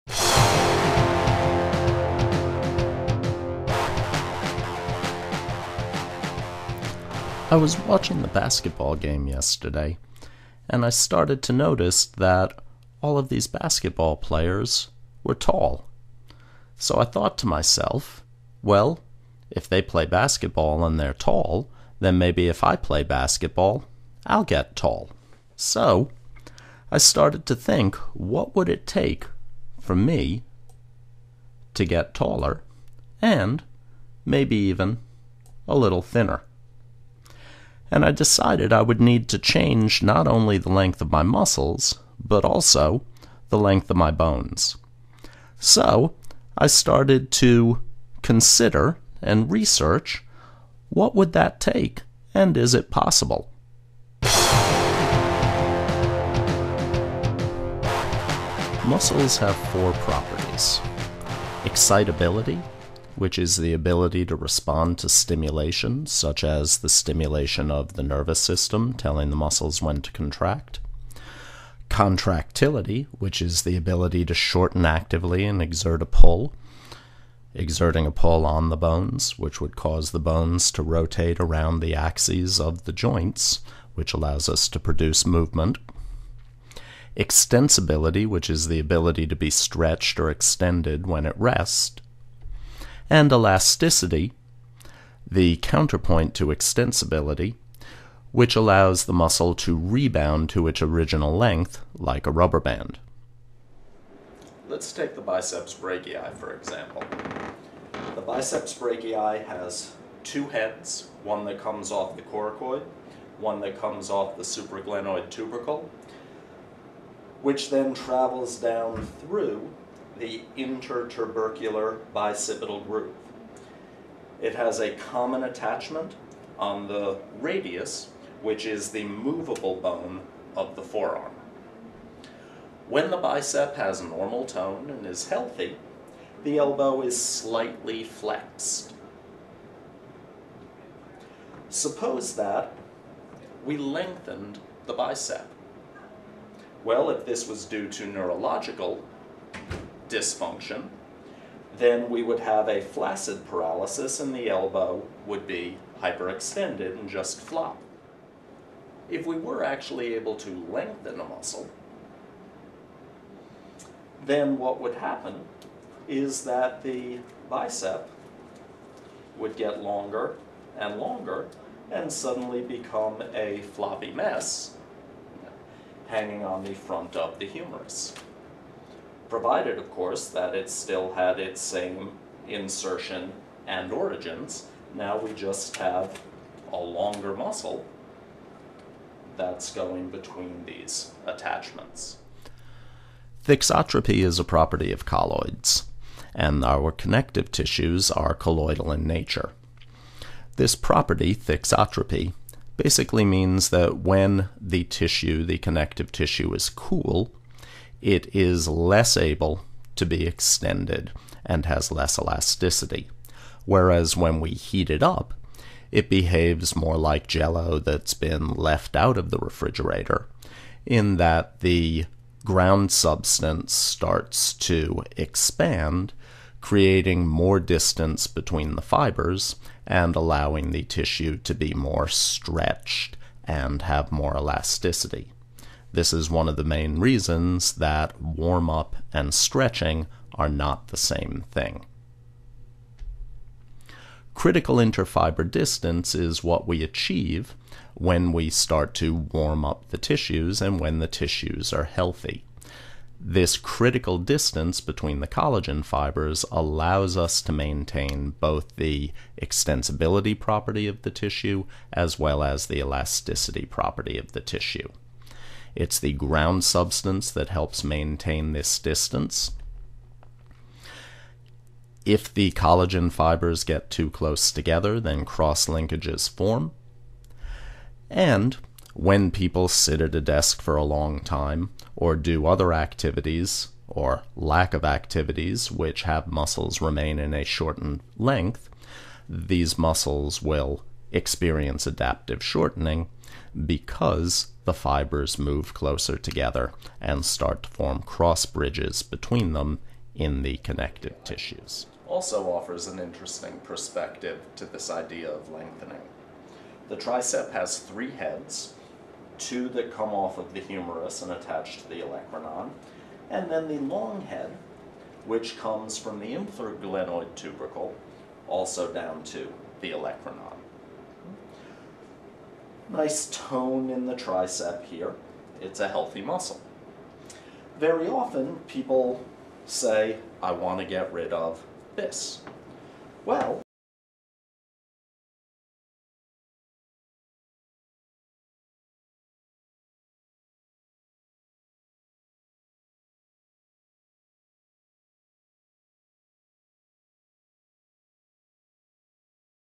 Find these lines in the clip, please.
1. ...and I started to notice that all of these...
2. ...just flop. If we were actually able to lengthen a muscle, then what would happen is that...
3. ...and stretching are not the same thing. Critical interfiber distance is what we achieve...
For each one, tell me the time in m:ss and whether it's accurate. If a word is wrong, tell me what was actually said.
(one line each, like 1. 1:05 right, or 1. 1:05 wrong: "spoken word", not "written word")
1. 0:10 right
2. 2:37 right
3. 3:59 right.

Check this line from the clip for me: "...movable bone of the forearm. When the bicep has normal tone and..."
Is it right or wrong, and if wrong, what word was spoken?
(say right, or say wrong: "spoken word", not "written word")
right.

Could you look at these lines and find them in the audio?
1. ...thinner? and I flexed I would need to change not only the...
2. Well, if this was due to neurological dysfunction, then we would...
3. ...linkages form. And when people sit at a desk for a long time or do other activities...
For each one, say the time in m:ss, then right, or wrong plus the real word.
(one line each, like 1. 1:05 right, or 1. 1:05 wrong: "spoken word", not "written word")
1. 0:36 wrong: "decided", not "flexed"
2. 2:26 right
3. 4:35 right.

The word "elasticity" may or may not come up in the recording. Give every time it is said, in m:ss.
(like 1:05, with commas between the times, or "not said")
1:33, 3:32, 3:54, 4:22.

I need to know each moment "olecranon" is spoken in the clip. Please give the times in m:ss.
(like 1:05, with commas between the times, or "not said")
5:12, 5:19.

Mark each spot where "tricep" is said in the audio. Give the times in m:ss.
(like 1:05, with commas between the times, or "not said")
5:06, 5:24.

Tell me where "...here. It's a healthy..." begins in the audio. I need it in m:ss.
5:24.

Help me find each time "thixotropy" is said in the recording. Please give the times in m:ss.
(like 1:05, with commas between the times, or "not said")
3:13, 3:21.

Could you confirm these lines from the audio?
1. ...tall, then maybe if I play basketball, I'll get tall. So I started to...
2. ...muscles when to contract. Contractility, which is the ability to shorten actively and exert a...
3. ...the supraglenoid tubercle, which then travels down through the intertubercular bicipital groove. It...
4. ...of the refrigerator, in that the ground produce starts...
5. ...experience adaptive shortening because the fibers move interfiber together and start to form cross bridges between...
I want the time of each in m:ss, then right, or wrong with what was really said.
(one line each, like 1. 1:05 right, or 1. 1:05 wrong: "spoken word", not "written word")
1. 0:21 right
2. 1:09 right
3. 1:54 right
4. 3:39 wrong: "substance", not "produce"
5. 4:51 wrong: "closer", not "interfiber".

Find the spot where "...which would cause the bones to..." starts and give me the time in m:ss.
1:19.